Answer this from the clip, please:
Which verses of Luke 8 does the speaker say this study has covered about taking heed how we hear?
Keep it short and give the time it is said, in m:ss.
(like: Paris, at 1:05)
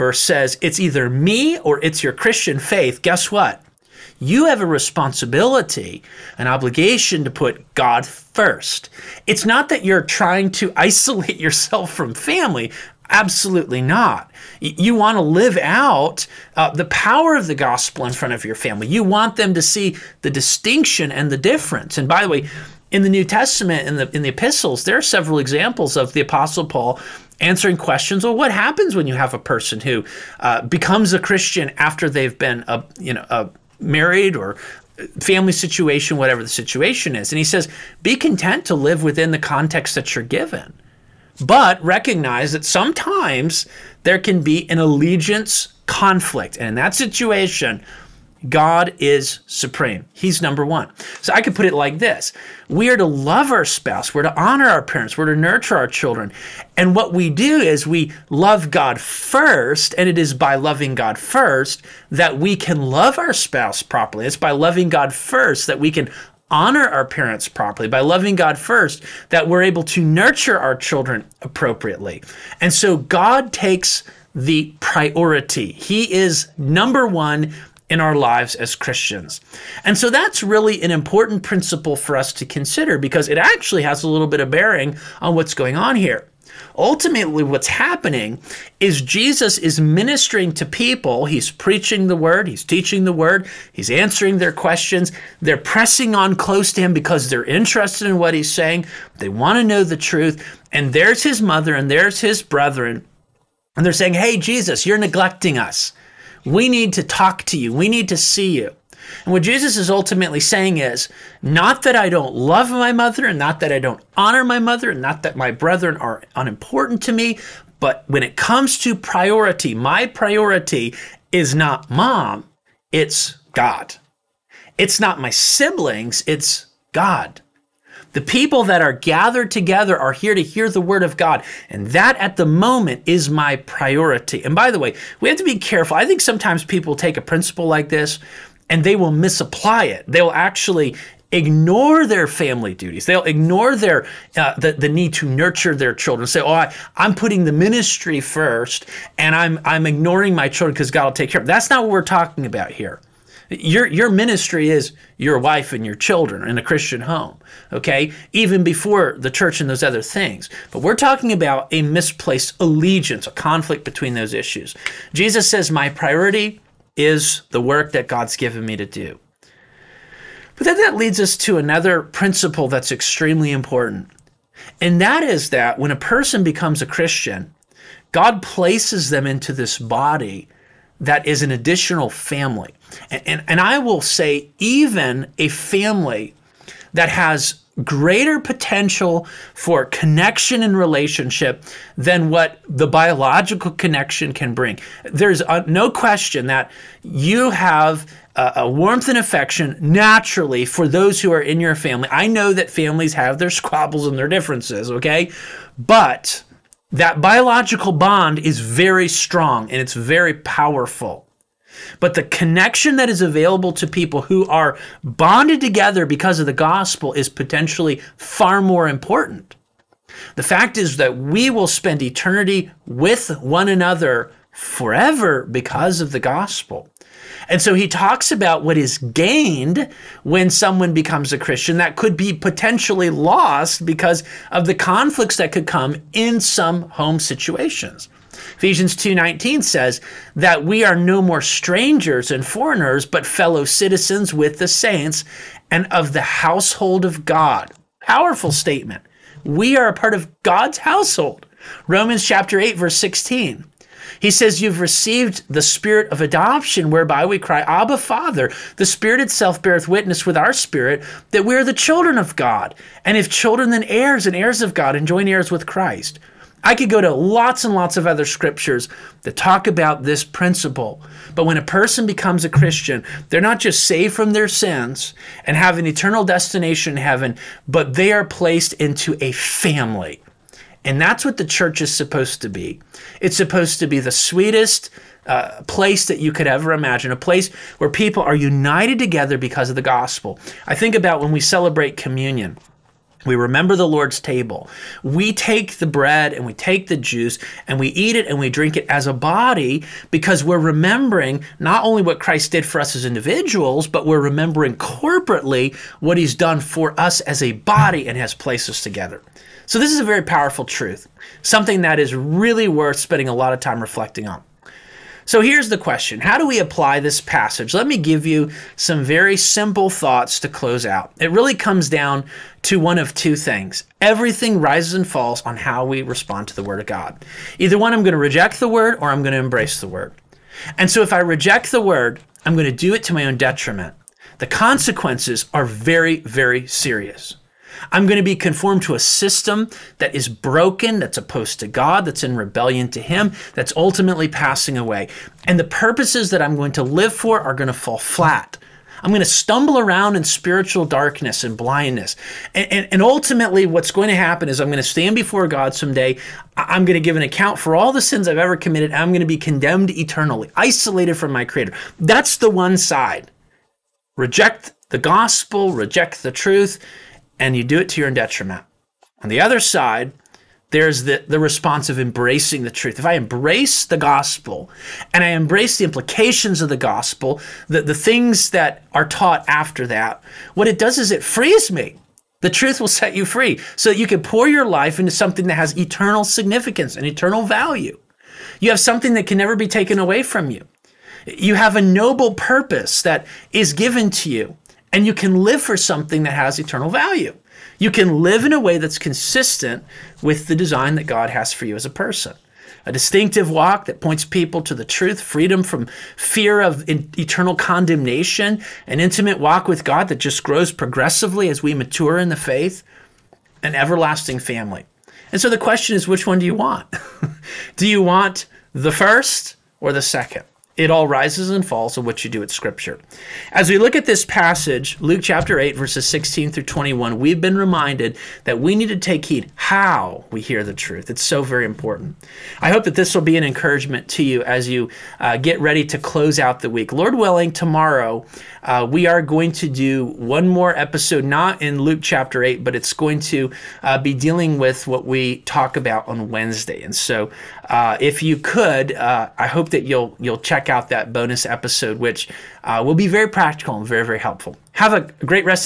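16 through 21, at 7:05.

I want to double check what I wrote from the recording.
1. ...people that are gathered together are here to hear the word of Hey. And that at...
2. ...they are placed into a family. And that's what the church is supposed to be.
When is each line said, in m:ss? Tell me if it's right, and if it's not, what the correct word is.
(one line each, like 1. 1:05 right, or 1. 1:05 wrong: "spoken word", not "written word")
1. 2:08 wrong: "God", not "Hey"
2. 4:37 right.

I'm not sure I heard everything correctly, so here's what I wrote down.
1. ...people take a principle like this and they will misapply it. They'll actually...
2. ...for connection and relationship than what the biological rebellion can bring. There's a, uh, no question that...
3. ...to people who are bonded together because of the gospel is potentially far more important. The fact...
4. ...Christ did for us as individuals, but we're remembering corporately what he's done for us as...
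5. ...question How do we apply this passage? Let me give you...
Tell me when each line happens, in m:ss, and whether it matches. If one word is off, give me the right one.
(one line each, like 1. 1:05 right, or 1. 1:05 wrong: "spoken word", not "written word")
1. 2:16 right
2. 3:09 wrong: "connection", not "rebellion"
3. 3:33 right
4. 5:02 right
5. 5:15 right.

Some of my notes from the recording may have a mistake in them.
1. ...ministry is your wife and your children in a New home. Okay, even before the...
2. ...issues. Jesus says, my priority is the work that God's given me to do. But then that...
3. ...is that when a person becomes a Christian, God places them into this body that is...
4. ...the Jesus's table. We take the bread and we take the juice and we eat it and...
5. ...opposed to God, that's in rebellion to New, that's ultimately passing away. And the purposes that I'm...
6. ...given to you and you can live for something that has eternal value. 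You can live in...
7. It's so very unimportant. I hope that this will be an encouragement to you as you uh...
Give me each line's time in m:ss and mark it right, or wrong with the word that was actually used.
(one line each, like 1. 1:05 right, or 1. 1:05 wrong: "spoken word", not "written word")
1. 2:34 wrong: "Christian", not "New"
2. 2:44 right
3. 2:55 right
4. 4:53 wrong: "Lord", not "Jesus"
5. 5:41 wrong: "Him", not "New"
6. 6:33 right
7. 7:11 wrong: "important", not "unimportant".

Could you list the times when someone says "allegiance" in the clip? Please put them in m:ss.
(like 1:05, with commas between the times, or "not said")
0:44, 2:42.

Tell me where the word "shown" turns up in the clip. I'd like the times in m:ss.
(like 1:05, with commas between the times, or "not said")
not said.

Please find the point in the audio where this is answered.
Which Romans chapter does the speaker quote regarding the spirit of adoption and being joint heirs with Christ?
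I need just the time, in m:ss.
4:11.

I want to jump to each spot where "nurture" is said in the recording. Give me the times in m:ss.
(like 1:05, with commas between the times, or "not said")
0:55, 1:10, 2:25.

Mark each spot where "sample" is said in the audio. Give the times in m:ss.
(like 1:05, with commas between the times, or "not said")
not said.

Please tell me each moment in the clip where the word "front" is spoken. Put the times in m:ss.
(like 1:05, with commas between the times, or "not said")
0:18.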